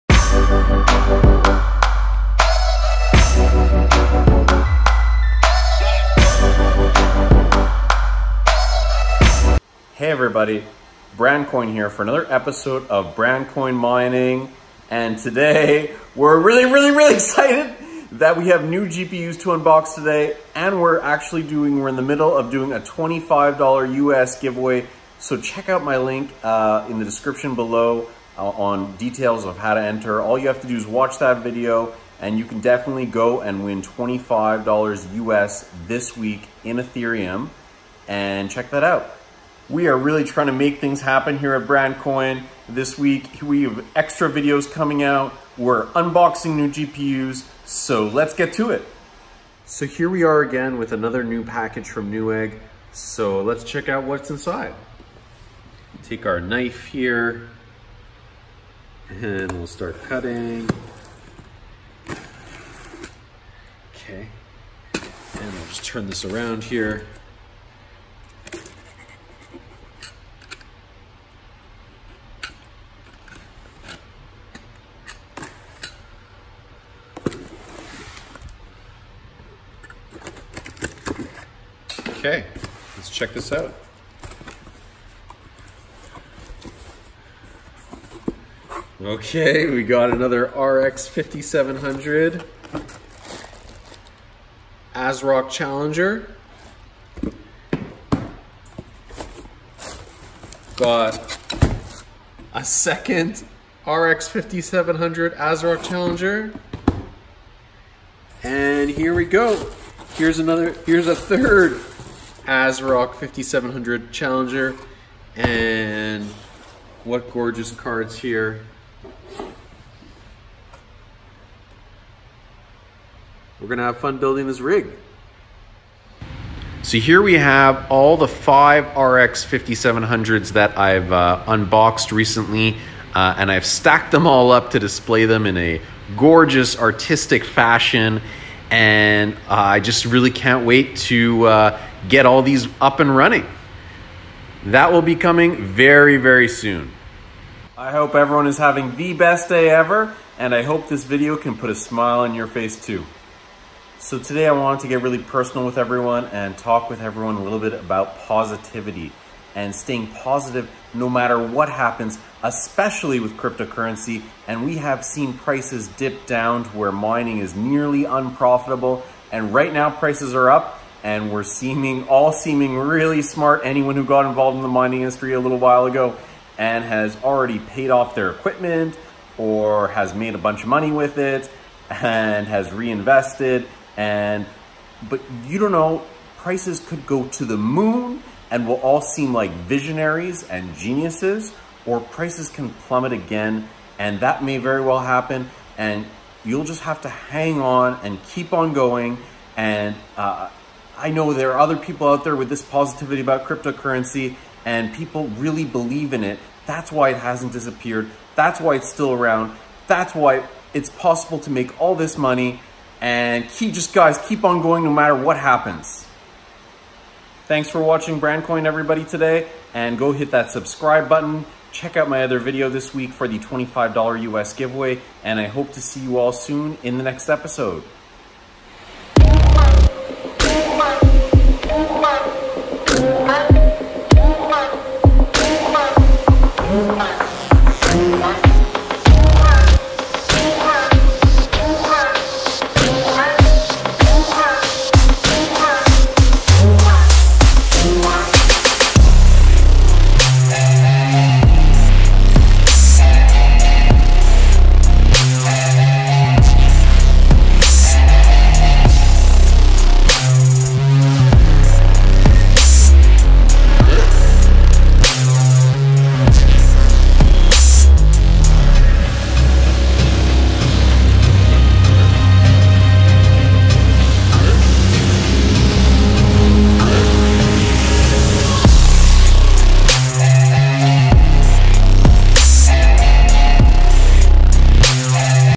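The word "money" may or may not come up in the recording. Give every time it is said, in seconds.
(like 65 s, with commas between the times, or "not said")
180 s, 212 s.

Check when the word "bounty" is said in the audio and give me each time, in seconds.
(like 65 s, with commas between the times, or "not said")
not said.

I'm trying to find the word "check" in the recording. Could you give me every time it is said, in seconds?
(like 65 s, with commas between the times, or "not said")
25 s, 38 s, 53 s, 83 s, 221 s.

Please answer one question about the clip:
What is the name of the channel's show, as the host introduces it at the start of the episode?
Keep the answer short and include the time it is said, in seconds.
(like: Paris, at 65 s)
Brandcoin Mining, at 13 s.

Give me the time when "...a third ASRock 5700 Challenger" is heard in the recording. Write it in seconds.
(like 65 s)
111 s.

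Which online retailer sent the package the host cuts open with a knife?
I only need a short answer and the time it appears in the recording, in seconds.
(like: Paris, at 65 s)
Newegg, at 52 s.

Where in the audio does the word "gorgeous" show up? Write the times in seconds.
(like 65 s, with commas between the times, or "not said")
117 s, 136 s.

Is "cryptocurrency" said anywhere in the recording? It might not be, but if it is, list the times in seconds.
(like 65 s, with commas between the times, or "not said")
163 s, 203 s.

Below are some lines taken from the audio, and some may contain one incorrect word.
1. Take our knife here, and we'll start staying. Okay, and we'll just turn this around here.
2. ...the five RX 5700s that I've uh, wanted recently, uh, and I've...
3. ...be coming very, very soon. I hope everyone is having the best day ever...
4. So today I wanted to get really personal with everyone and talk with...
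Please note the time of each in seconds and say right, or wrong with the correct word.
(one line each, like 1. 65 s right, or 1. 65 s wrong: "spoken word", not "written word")
1. 56 s wrong: "cutting", not "staying"
2. 128 s wrong: "unboxed", not "wanted"
3. 145 s right
4. 154 s right.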